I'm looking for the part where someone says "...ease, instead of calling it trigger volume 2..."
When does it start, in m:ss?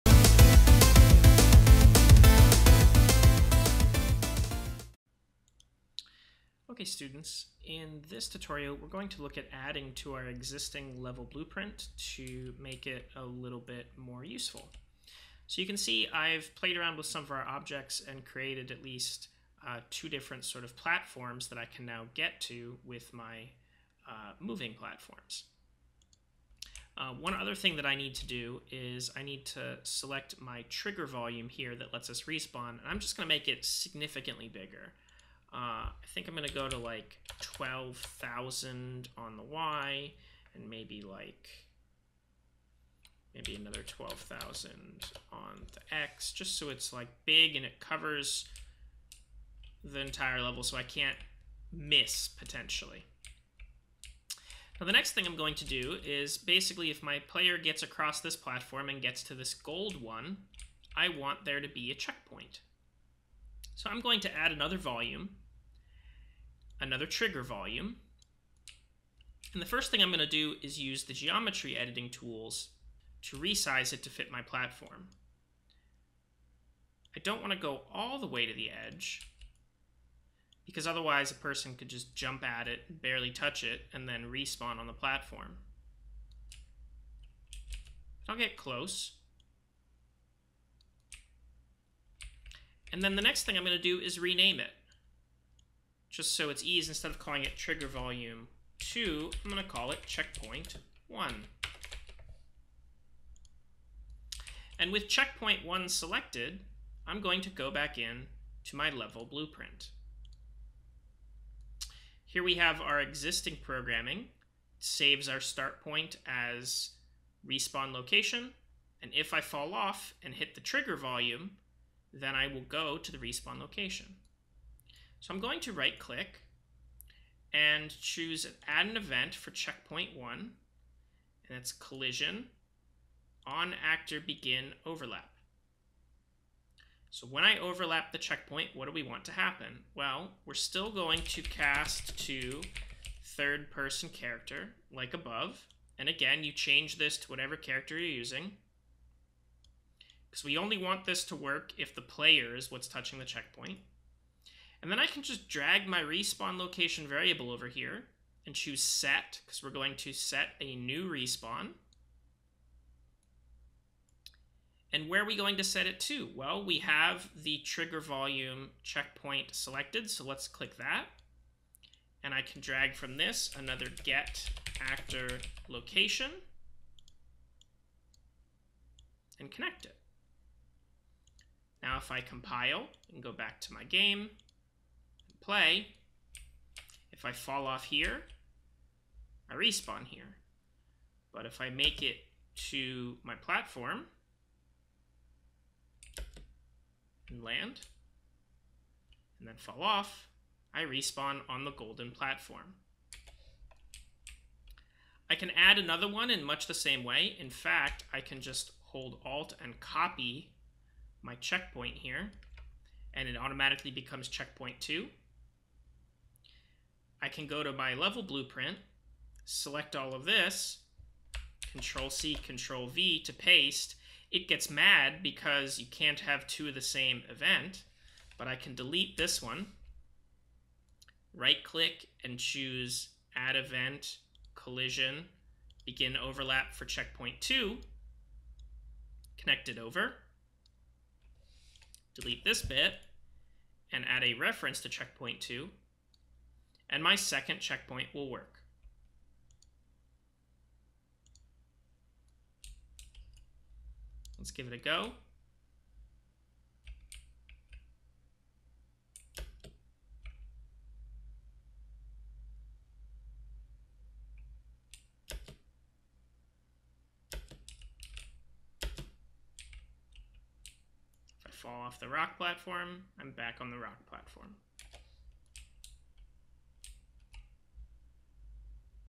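1:36.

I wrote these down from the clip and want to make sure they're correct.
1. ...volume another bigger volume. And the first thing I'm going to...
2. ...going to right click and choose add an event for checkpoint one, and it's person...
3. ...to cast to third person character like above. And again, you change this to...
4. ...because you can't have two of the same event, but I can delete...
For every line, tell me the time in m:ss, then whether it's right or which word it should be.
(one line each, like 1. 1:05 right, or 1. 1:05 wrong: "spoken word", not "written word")
1. 1:04 wrong: "trigger", not "bigger"
2. 2:05 wrong: "collision", not "person"
3. 2:21 right
4. 3:45 right.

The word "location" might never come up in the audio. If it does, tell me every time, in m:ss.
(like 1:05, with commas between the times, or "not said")
1:57, 2:03, 2:36, 2:55.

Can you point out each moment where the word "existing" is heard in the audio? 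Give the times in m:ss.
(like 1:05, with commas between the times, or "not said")
0:10, 1:52.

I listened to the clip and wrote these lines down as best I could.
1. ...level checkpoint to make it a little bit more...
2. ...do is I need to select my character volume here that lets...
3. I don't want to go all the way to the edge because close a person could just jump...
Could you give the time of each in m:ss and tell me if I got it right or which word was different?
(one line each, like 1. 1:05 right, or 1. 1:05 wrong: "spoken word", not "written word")
1. 0:11 wrong: "blueprint", not "checkpoint"
2. 0:28 wrong: "trigger", not "character"
3. 1:17 wrong: "otherwise", not "close".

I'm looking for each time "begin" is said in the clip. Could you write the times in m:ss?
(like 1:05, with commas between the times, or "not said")
2:14, 3:55.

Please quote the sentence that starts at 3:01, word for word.
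Now if I compile and go back to my game, play, if I fall off here, I respawn here.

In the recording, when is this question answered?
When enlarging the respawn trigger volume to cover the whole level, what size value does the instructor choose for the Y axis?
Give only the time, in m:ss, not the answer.
0:37.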